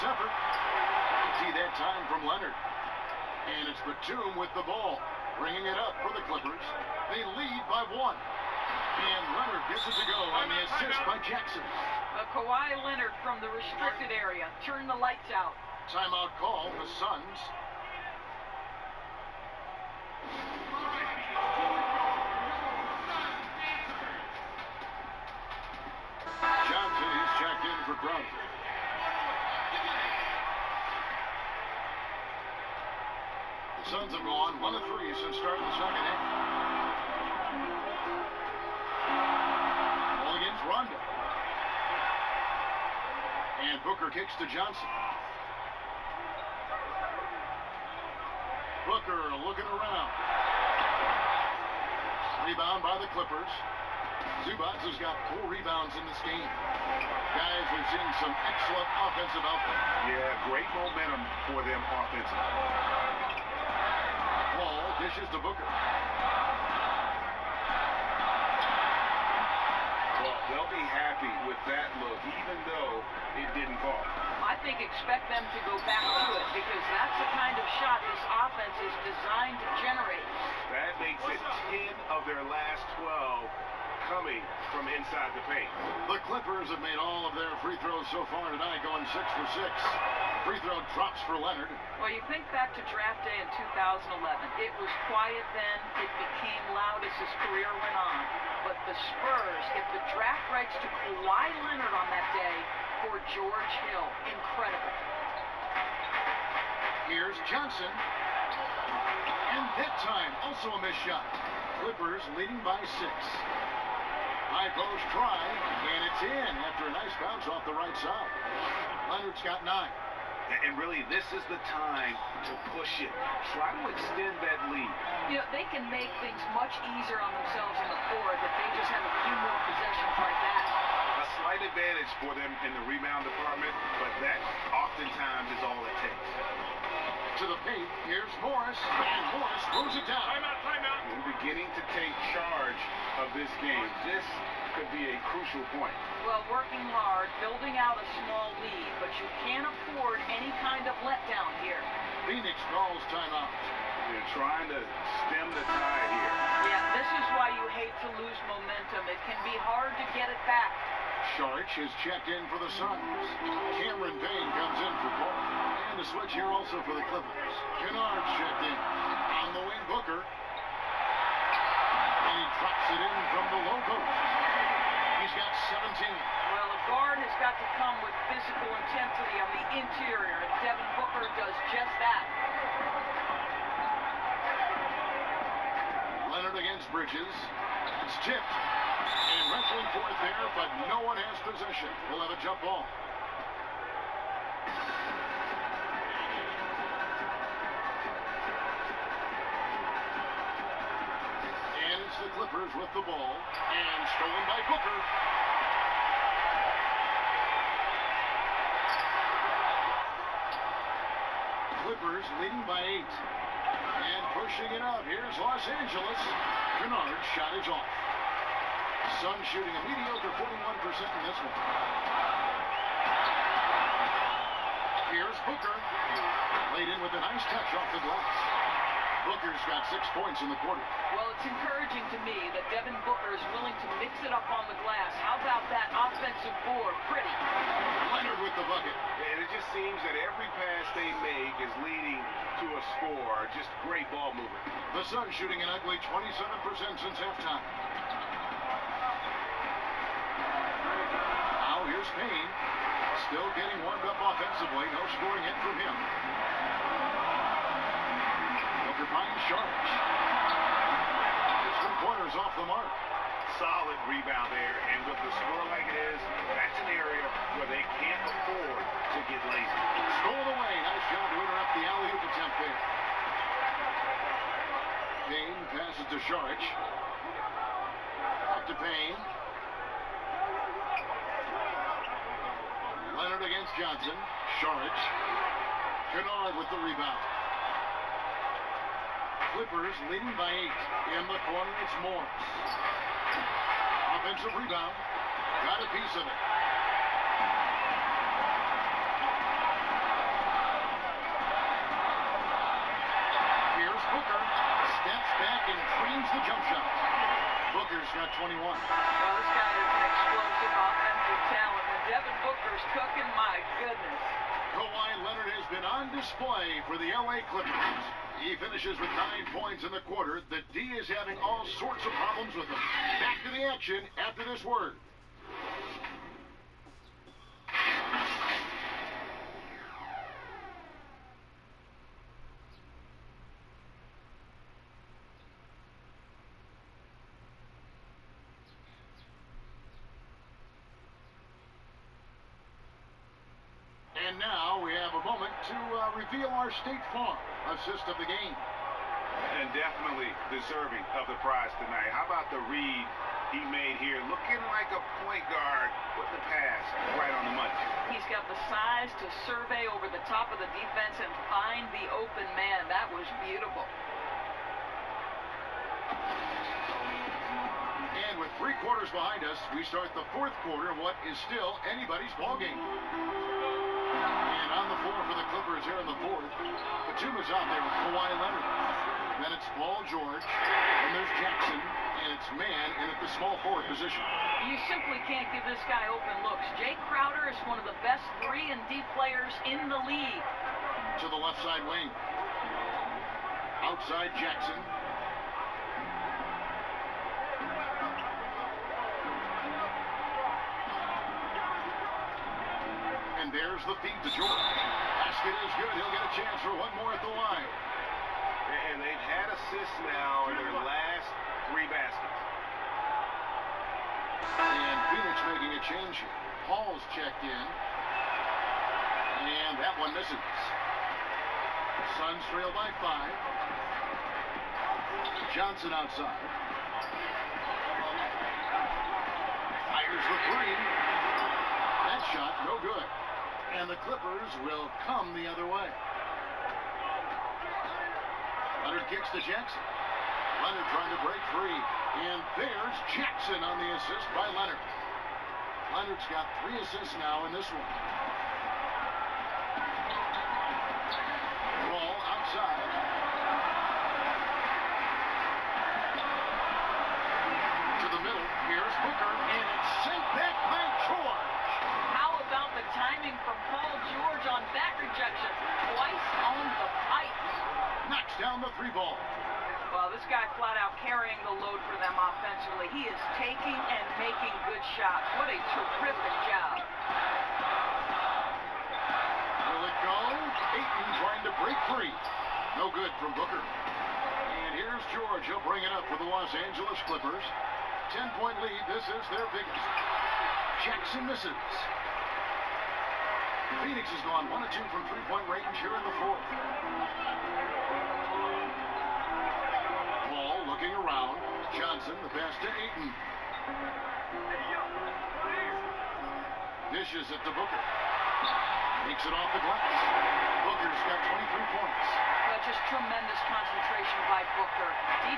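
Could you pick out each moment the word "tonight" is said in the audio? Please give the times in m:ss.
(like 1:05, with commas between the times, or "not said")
1:28, 5:51.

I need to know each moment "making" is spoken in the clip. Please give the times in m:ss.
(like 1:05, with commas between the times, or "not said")
6:55, 7:54.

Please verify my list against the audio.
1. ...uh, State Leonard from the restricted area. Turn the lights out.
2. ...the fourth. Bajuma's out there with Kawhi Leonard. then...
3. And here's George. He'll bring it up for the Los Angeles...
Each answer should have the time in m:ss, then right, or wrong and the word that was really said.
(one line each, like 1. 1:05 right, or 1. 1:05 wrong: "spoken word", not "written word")
1. 0:12 wrong: "Kawhi", not "State"
2. 6:16 right
3. 8:03 right.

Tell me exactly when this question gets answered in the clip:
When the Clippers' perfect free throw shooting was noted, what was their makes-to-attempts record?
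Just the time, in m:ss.
1:29.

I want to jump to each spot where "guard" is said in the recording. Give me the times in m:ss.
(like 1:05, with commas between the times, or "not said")
2:56, 5:55.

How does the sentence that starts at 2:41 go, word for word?
Sharks has checked in for the Suns.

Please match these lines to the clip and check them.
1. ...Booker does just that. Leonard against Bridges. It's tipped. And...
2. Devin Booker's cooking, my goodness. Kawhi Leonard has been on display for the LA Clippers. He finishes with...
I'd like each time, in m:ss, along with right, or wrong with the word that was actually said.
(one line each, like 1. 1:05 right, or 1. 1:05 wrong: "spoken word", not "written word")
1. 3:00 right
2. 5:12 right.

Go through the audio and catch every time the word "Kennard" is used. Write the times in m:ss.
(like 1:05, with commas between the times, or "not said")
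2:47, 3:36, 4:46.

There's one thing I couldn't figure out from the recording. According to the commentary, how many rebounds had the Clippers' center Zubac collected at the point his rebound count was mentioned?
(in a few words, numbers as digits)
4.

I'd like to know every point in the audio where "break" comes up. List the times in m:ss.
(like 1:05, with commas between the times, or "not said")
7:21, 8:01.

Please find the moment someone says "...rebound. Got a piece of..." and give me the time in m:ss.
4:54.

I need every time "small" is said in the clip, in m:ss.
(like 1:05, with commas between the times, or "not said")
2:28, 6:23.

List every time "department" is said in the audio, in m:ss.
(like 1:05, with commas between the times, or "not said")
2:13.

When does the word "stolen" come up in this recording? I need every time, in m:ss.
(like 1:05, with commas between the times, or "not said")
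3:24, 4:30.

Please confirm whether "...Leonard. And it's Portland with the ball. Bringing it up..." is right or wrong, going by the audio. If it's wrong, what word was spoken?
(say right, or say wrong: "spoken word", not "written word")
wrong: "Batum", not "Portland".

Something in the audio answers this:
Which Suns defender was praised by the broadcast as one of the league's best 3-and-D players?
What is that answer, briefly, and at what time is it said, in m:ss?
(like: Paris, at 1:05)
Jae Crowder, at 6:26.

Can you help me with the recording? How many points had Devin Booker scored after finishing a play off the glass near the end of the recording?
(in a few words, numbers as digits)
23.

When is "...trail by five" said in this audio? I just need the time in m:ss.
7:02.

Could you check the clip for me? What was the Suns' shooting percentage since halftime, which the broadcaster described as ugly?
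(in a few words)
27%.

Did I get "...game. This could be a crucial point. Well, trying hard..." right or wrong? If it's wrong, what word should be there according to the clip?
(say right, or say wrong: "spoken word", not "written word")
wrong: "working", not "trying".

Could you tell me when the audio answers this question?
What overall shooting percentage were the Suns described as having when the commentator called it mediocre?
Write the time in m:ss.
3:40.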